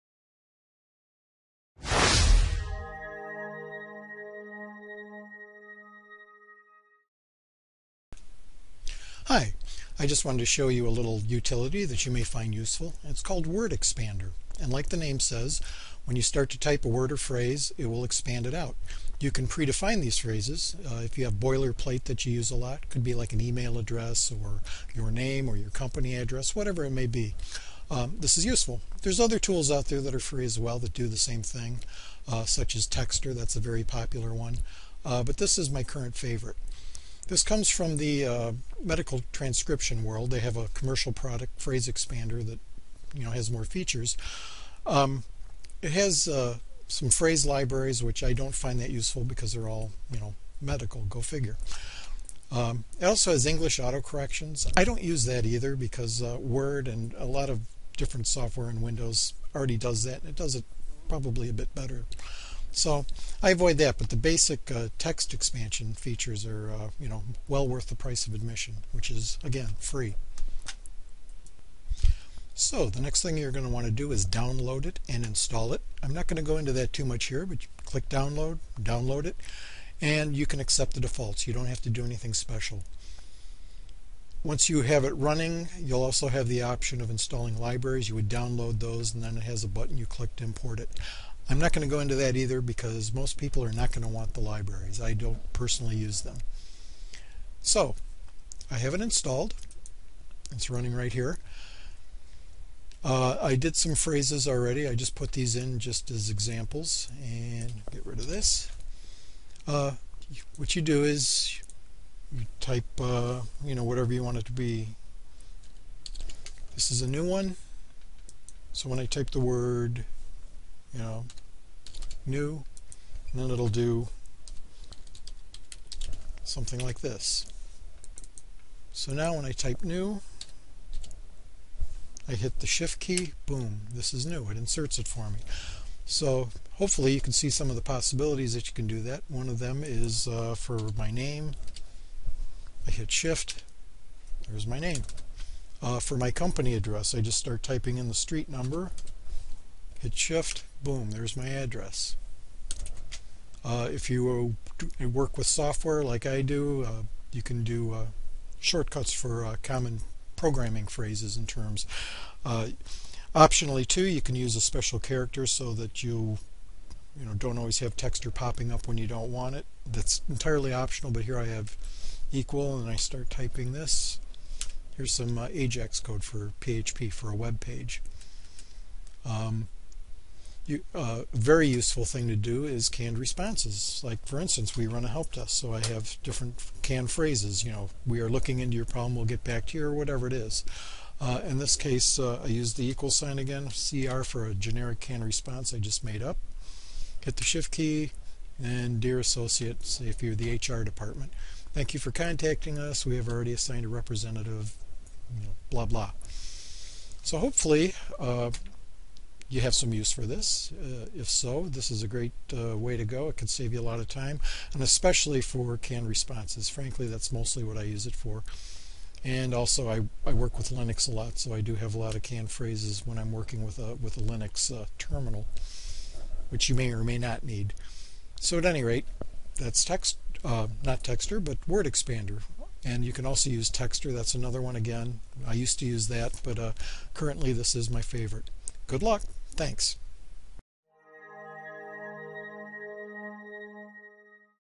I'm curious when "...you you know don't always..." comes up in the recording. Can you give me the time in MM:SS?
02:46.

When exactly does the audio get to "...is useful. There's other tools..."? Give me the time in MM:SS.
00:28.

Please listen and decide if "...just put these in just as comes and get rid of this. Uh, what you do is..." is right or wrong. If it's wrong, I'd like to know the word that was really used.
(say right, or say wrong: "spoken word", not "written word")
wrong: "examples", not "comes".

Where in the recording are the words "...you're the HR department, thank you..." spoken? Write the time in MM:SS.
03:20.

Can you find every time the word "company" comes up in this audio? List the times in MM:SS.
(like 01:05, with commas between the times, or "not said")
00:25, 02:26.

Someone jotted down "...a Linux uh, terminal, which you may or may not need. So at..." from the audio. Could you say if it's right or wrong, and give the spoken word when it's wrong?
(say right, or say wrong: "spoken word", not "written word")
right.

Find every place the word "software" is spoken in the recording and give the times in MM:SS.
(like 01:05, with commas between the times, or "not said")
00:58, 02:35.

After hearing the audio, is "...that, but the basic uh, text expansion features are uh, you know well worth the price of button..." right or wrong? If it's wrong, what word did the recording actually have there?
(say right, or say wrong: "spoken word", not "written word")
wrong: "admission", not "button".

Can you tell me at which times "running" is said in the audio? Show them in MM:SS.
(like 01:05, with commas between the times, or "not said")
01:25, 01:40.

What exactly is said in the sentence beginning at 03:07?
You know, we are looking into your problem, we'll get back to you, or whatever it is.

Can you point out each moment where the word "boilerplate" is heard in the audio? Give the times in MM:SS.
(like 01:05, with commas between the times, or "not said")
00:21.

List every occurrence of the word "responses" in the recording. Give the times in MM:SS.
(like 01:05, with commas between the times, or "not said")
03:03, 03:15, 03:36.